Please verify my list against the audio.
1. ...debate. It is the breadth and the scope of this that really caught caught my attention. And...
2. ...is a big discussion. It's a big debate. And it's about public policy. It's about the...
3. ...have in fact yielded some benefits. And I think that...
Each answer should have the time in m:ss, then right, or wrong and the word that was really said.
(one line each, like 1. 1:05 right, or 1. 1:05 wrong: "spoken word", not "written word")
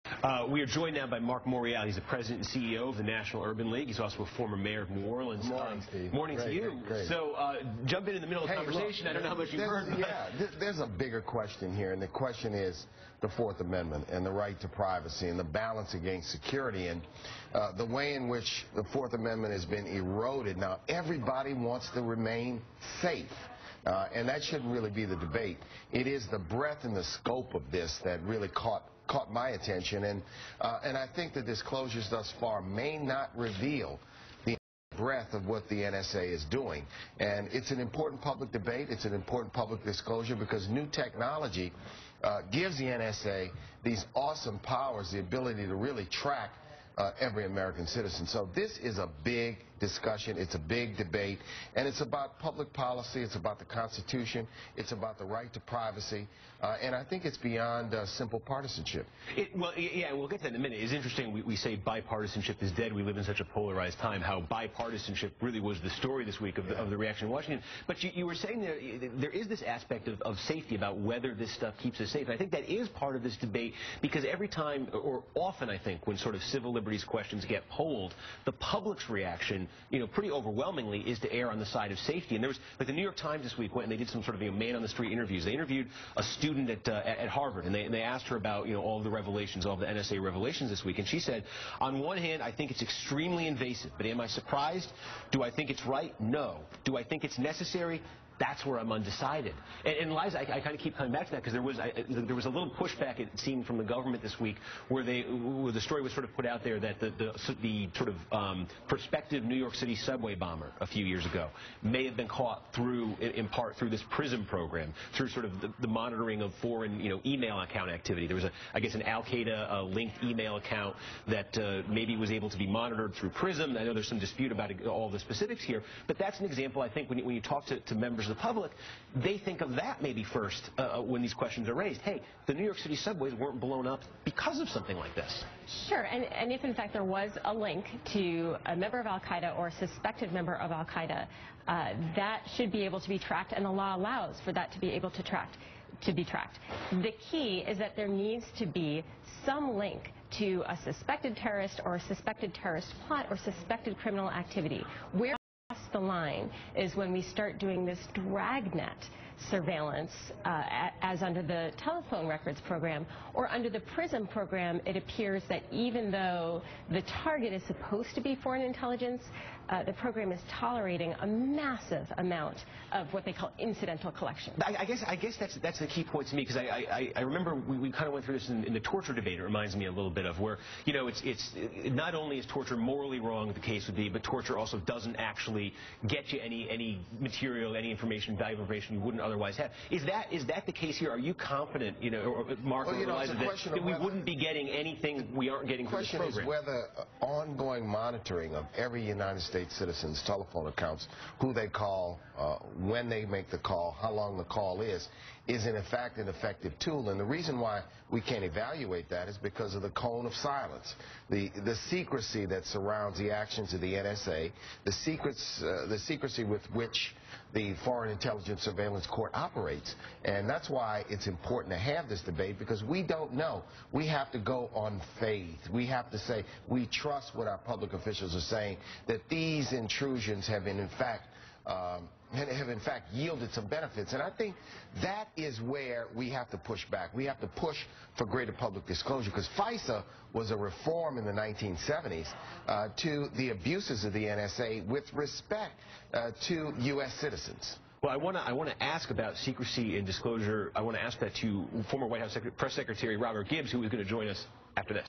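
1. 0:25 right
2. 0:48 right
3. 3:52 right.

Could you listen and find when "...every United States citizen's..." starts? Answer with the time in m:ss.
3:18.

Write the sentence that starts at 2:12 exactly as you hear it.
Hey, the New York City subways weren't blown up because of something like this.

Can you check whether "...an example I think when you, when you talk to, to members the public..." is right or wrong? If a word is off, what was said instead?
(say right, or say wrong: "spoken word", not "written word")
right.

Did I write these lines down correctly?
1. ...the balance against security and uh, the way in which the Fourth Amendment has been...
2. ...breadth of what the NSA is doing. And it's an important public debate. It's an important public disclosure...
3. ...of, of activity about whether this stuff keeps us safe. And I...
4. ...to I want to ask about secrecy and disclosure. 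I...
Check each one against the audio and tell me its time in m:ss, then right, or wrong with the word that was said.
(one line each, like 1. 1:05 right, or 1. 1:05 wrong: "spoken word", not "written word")
1. 0:15 right
2. 0:34 right
3. 1:10 wrong: "safety", not "activity"
4. 4:08 right.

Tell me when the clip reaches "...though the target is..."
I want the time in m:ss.
2:46.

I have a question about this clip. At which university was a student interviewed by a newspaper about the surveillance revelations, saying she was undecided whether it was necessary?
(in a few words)
Harvard.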